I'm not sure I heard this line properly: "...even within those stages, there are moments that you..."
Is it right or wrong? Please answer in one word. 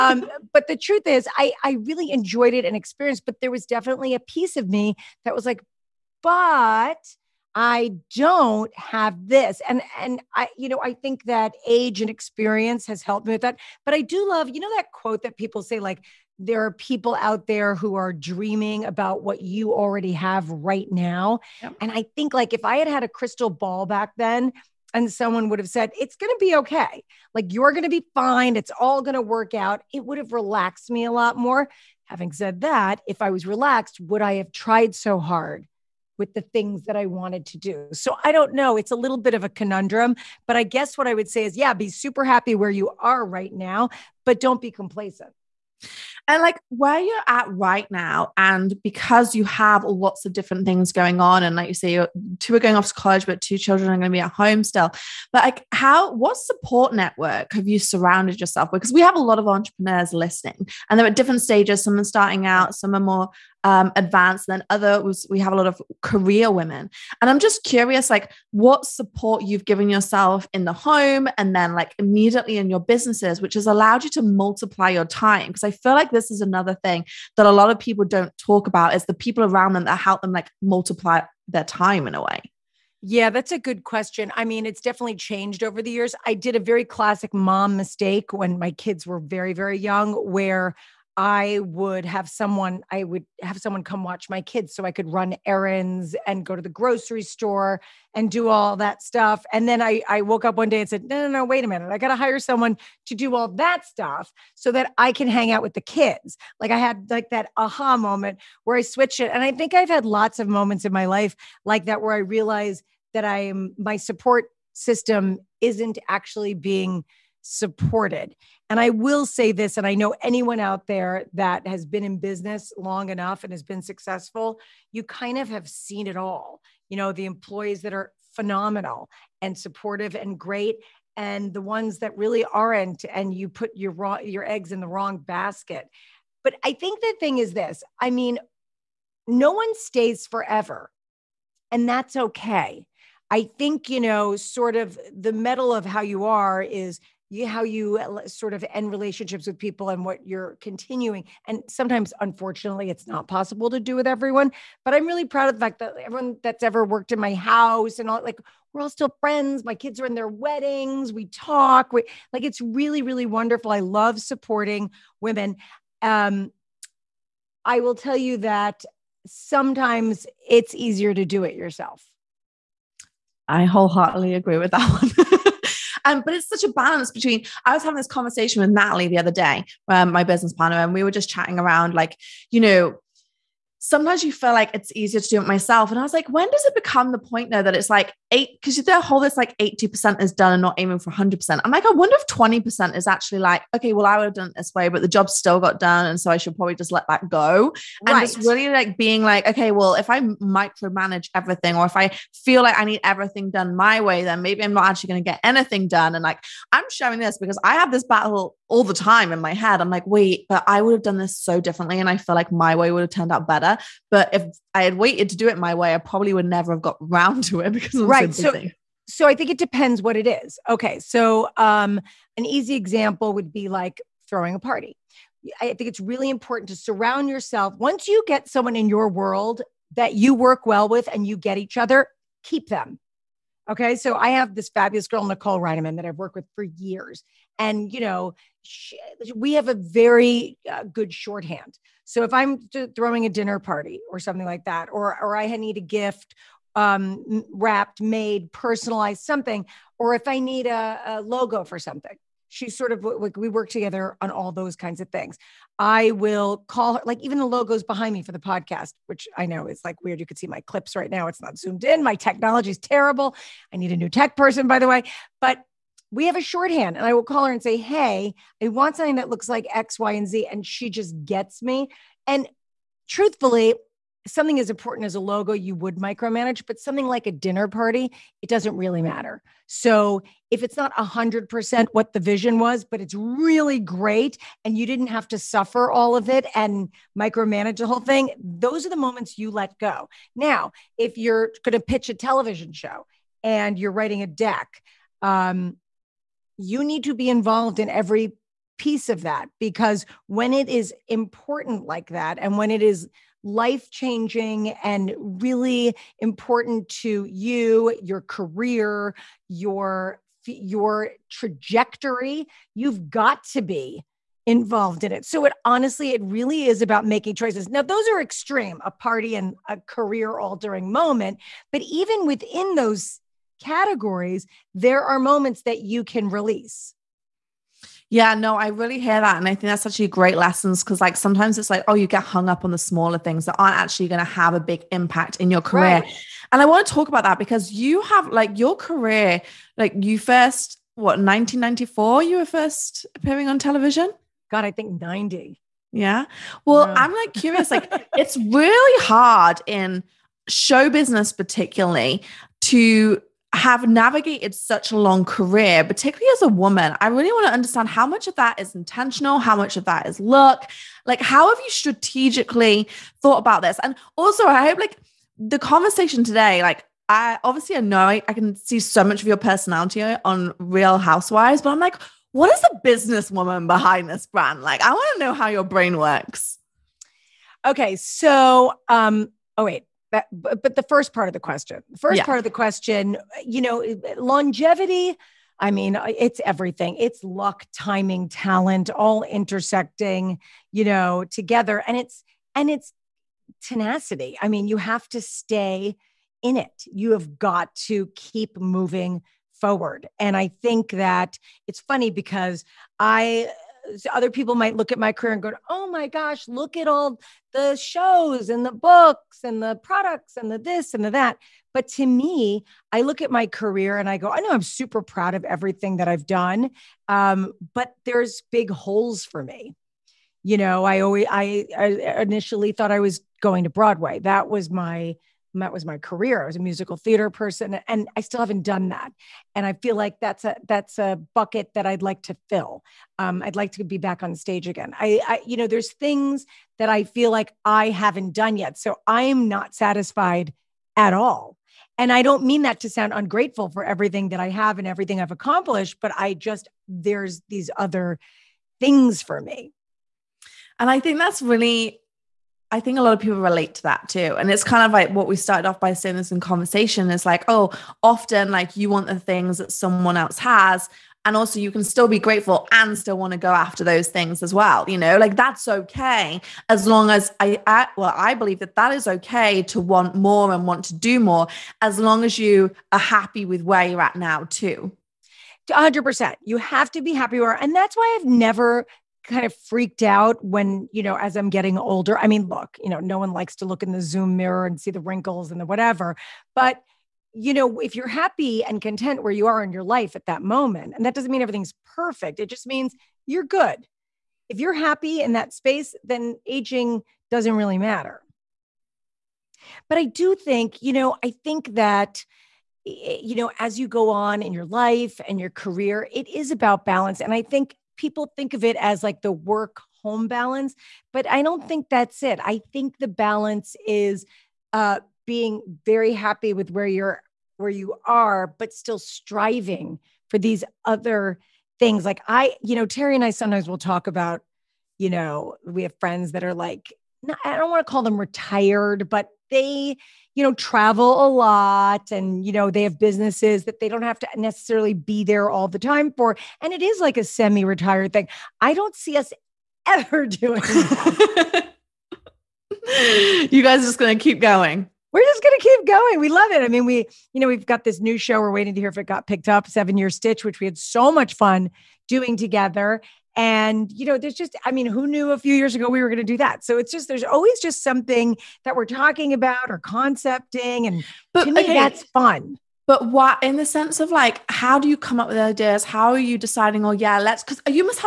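wrong.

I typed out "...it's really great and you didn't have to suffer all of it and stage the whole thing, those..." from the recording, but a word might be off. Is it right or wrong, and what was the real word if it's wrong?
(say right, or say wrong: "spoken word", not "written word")
wrong: "micromanage", not "stage".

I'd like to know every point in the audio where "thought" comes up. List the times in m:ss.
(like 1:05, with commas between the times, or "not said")
6:03, 7:02.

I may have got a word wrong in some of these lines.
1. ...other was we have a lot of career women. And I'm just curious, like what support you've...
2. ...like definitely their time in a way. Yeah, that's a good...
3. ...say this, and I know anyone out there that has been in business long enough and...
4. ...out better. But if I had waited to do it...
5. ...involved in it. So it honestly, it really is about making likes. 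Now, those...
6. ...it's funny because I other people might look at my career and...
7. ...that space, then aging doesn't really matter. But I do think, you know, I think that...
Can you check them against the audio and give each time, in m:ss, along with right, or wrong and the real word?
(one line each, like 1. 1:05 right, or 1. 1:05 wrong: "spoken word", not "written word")
1. 1:04 right
2. 1:20 wrong: "multiply", not "definitely"
3. 1:59 right
4. 3:33 right
5. 5:14 wrong: "choices", not "likes"
6. 6:41 right
7. 8:15 right.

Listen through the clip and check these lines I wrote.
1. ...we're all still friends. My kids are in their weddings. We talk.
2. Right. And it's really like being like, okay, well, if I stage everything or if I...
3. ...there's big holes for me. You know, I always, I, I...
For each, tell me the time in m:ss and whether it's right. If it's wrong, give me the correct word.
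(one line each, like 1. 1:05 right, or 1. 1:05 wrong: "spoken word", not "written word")
1. 2:38 right
2. 3:18 wrong: "micromanage", not "stage"
3. 6:58 right.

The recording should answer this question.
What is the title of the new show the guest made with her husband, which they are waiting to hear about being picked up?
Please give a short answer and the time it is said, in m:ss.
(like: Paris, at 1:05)
Seven Year Stitch, at 9:09.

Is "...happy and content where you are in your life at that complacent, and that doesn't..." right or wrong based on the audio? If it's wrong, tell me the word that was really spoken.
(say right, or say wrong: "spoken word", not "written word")
wrong: "moment", not "complacent".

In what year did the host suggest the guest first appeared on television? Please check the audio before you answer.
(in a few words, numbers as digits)
1994.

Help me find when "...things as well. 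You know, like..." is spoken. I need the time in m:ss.
7:44.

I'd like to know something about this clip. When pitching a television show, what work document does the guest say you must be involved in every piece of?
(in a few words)
a deck.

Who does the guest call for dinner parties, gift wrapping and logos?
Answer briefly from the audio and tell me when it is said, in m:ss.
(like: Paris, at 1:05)
Nicole Reineman, at 3:55.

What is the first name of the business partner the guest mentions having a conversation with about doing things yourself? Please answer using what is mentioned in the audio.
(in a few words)
Natalie.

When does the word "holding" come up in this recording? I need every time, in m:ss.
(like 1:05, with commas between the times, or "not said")
not said.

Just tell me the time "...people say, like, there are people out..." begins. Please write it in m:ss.
0:15.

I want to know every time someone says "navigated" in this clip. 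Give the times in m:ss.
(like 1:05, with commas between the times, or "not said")
5:53.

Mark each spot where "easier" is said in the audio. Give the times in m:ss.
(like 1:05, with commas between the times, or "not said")
2:50, 3:04.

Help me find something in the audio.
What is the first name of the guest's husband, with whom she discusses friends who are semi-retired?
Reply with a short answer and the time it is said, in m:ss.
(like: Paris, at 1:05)
Terry, at 8:42.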